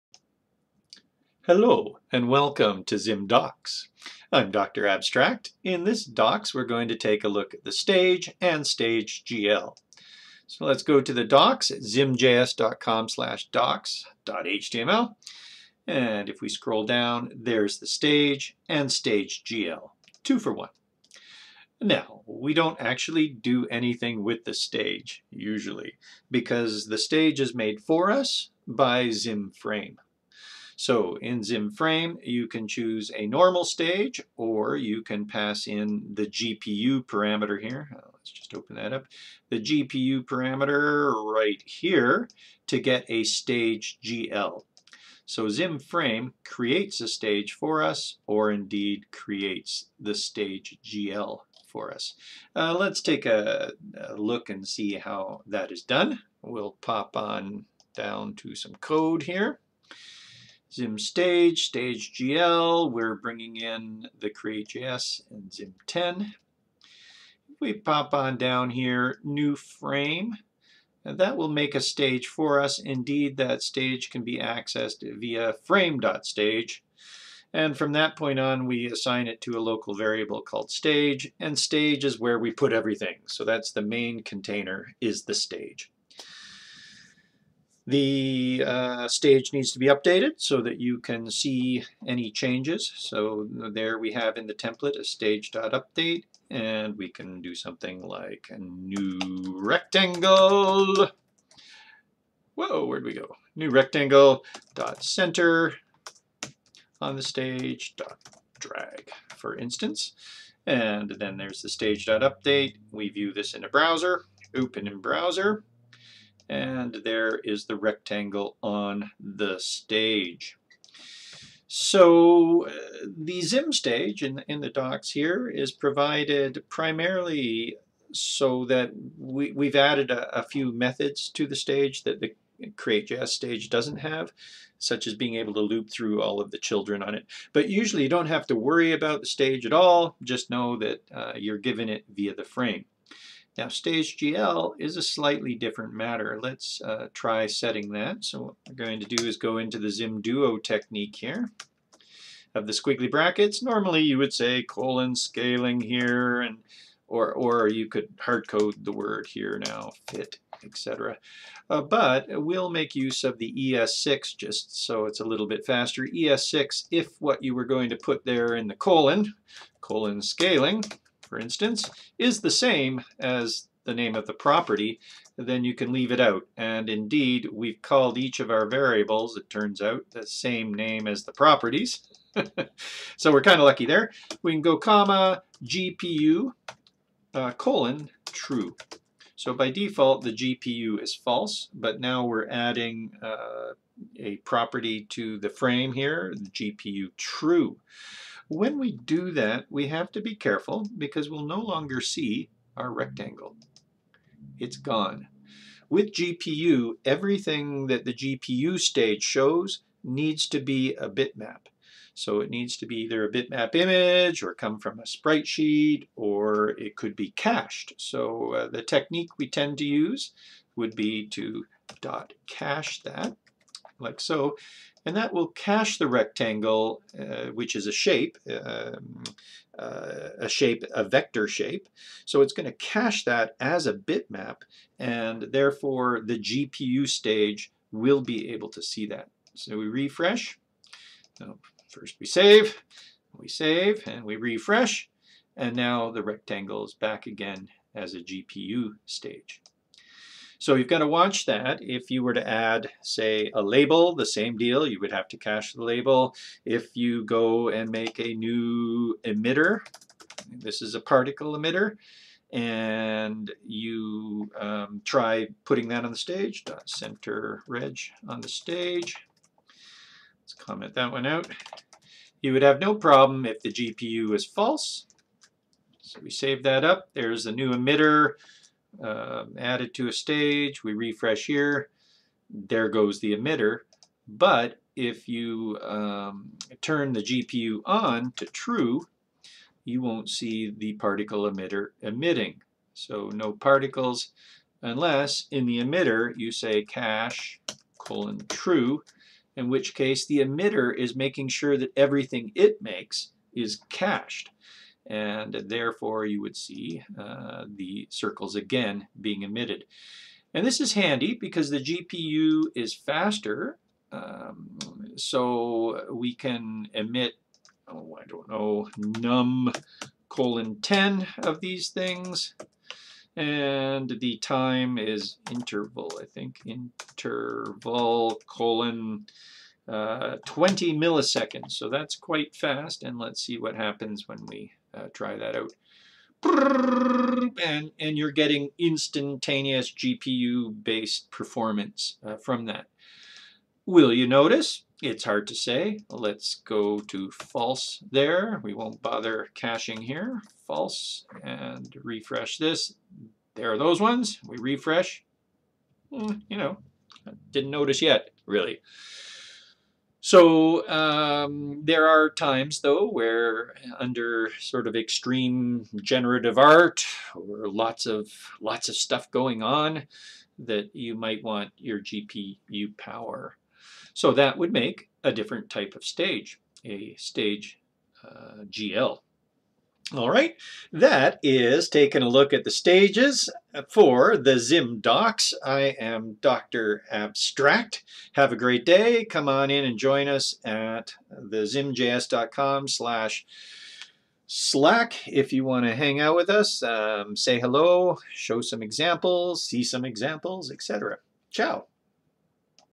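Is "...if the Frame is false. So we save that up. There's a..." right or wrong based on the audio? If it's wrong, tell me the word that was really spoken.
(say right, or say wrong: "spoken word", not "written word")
wrong: "GPU", not "Frame".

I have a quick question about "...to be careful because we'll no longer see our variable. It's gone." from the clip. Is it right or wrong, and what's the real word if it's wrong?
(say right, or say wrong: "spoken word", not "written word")
wrong: "rectangle", not "variable".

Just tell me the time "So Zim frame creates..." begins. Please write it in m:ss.
0:45.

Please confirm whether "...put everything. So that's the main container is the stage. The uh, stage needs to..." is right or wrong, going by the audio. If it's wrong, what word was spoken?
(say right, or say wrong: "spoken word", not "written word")
right.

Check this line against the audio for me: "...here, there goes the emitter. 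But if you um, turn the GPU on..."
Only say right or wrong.
right.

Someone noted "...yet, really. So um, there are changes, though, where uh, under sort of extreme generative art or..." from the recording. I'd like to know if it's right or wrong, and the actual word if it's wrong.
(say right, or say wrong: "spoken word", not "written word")
wrong: "times", not "changes".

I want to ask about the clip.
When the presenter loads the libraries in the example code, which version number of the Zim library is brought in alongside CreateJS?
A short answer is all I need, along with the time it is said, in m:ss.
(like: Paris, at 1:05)
Zim 10, at 1:05.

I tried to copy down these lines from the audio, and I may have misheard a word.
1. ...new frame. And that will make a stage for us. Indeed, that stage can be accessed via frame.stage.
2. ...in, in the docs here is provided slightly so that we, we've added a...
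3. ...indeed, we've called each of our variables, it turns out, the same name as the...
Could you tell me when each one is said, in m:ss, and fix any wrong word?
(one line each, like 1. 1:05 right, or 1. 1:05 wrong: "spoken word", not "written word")
1. 1:09 right
2. 2:04 wrong: "primarily", not "slightly"
3. 2:56 right.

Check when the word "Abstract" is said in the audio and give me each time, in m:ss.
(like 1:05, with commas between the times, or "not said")
0:04, 6:27.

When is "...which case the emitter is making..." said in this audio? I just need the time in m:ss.
4:59.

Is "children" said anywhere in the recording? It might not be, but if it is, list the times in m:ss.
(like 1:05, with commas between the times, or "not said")
2:16.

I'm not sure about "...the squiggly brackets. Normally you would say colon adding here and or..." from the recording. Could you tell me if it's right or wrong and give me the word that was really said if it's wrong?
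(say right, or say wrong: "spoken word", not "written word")
wrong: "scaling", not "adding".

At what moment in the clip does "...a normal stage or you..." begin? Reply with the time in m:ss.
0:33.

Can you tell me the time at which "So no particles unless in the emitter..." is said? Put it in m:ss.
4:52.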